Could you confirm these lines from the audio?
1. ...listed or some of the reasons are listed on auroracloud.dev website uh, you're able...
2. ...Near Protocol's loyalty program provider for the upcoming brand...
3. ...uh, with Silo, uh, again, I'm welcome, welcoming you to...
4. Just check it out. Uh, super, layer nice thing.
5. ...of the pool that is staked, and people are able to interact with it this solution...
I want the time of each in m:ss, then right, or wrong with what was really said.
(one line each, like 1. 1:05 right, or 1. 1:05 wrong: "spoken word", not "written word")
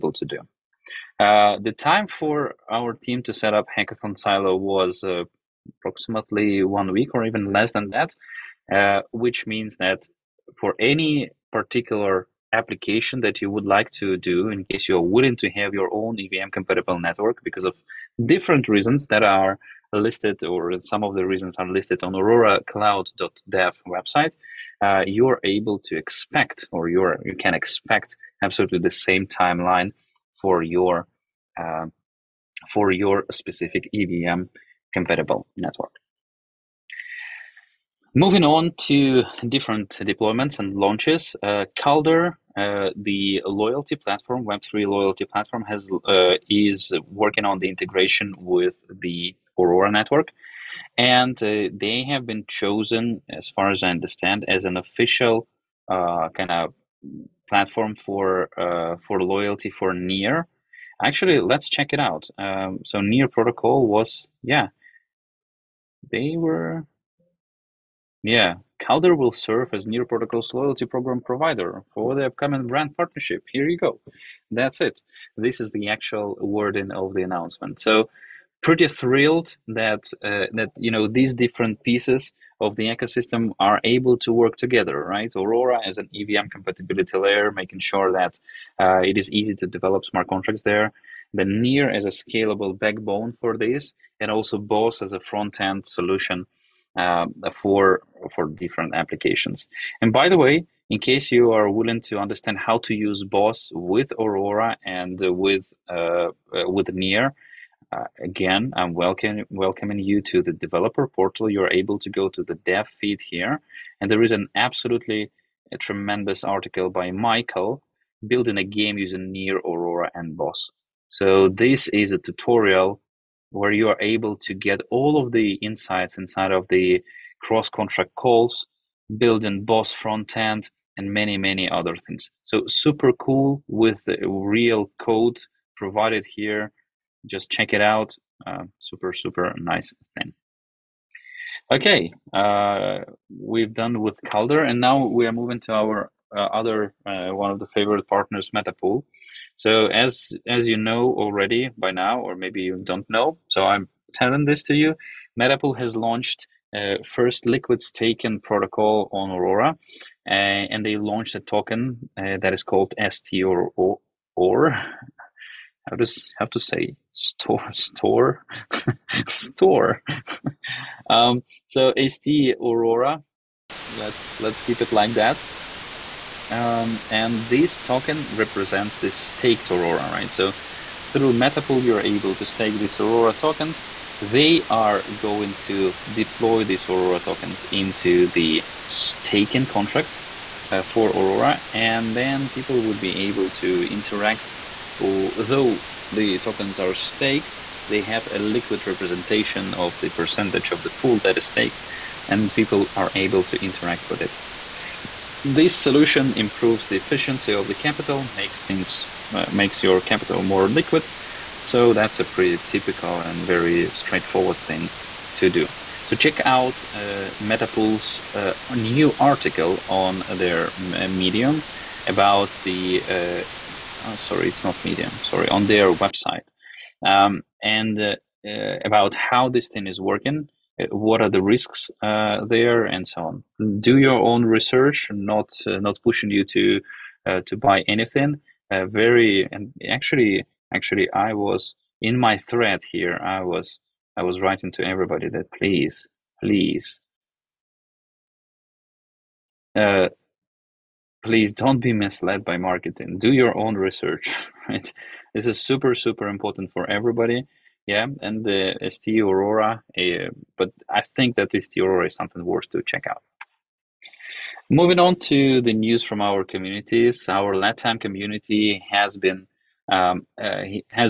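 1. 0:19 right
2. 1:09 right
3. 1:46 wrong: "Near", not "Silo"
4. 2:17 wrong: "super", not "layer"
5. 3:20 right.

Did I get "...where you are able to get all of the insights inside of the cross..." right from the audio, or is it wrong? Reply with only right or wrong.
right.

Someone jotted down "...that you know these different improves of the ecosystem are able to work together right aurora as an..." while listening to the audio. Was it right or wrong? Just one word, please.
wrong.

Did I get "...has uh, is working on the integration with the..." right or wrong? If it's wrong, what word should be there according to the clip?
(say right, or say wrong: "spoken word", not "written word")
right.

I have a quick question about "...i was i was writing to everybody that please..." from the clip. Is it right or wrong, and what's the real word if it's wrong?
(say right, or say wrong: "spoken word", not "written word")
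right.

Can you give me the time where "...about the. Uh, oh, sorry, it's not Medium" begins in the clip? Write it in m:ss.
3:42.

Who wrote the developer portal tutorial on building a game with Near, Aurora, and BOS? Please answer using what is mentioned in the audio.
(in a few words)
Michael.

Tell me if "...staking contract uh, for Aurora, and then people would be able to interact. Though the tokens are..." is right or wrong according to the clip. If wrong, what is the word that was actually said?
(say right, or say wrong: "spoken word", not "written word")
right.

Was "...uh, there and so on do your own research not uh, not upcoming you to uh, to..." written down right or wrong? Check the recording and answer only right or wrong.
wrong.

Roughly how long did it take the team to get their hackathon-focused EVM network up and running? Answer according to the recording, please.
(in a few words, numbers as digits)
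approximately one week.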